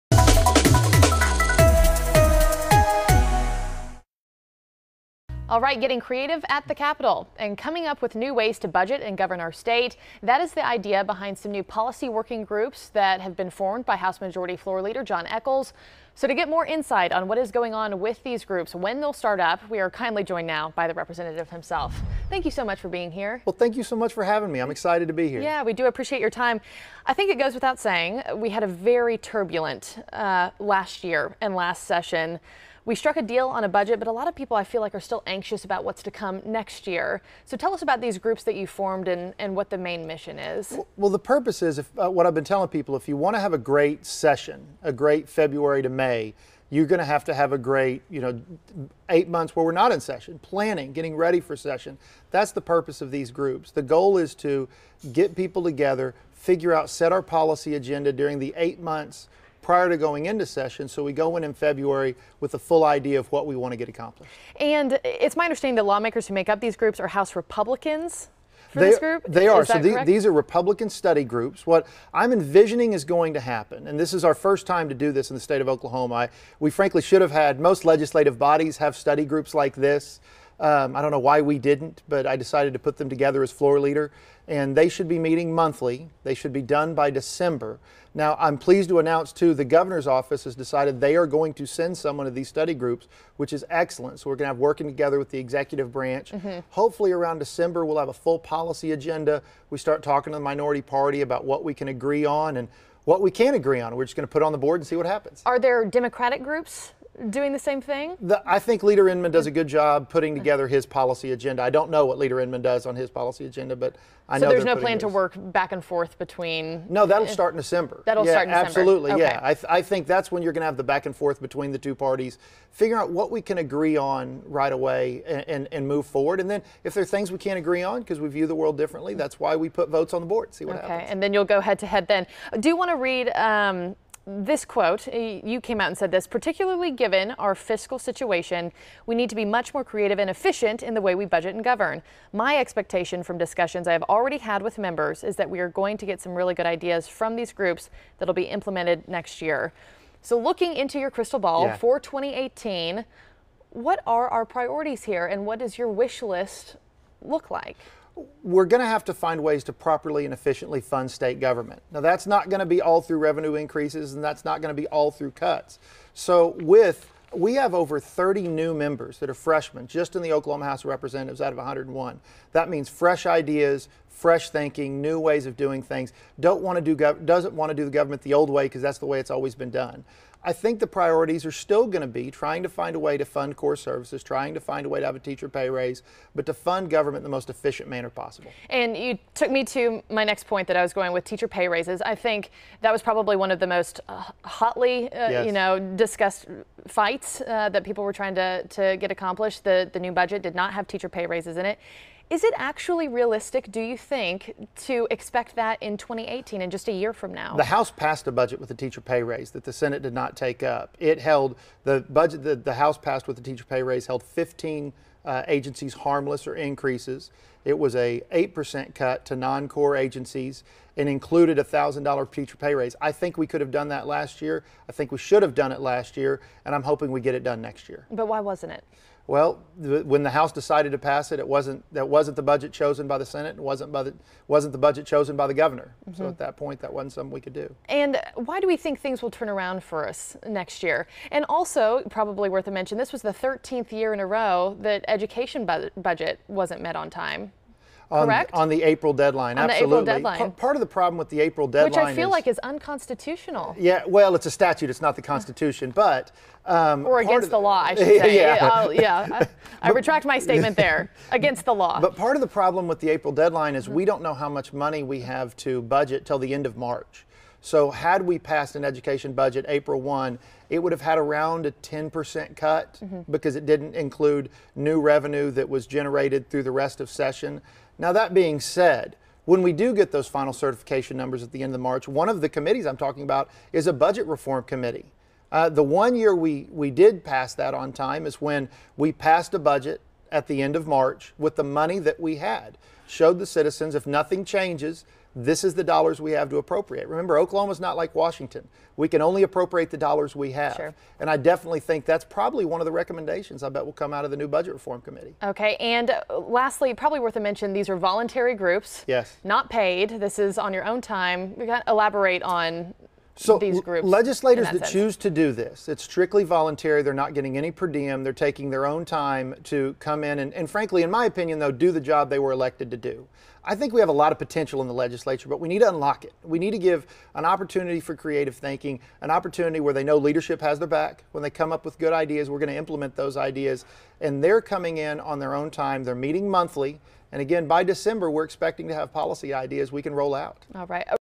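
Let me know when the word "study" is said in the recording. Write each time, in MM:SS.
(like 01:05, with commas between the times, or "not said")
01:10, 01:18, 01:32.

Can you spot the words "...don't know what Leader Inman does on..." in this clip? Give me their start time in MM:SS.
01:51.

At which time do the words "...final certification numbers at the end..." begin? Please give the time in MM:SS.
04:40.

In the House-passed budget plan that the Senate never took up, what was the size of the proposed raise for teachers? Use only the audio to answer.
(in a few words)
$1,000.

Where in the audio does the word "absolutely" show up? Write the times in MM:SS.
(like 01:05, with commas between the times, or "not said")
01:58, 04:09.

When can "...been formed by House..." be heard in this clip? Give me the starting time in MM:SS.
00:13.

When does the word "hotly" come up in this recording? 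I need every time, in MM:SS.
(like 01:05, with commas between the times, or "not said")
03:14.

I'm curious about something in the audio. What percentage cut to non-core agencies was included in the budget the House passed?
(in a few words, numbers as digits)
8%.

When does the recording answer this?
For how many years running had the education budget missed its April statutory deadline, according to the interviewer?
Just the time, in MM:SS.
04:03.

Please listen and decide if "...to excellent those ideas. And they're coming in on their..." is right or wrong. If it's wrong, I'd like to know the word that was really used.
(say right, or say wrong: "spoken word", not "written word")
wrong: "implement", not "excellent".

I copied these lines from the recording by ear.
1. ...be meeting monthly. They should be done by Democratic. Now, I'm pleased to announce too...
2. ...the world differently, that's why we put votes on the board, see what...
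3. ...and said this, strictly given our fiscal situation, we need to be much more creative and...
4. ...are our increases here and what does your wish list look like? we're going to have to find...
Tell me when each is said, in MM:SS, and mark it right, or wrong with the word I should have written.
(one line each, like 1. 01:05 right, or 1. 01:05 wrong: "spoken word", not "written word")
1. 01:25 wrong: "December", not "Democratic"
2. 02:08 right
3. 02:15 wrong: "particularly", not "strictly"
4. 02:34 wrong: "priorities", not "increases".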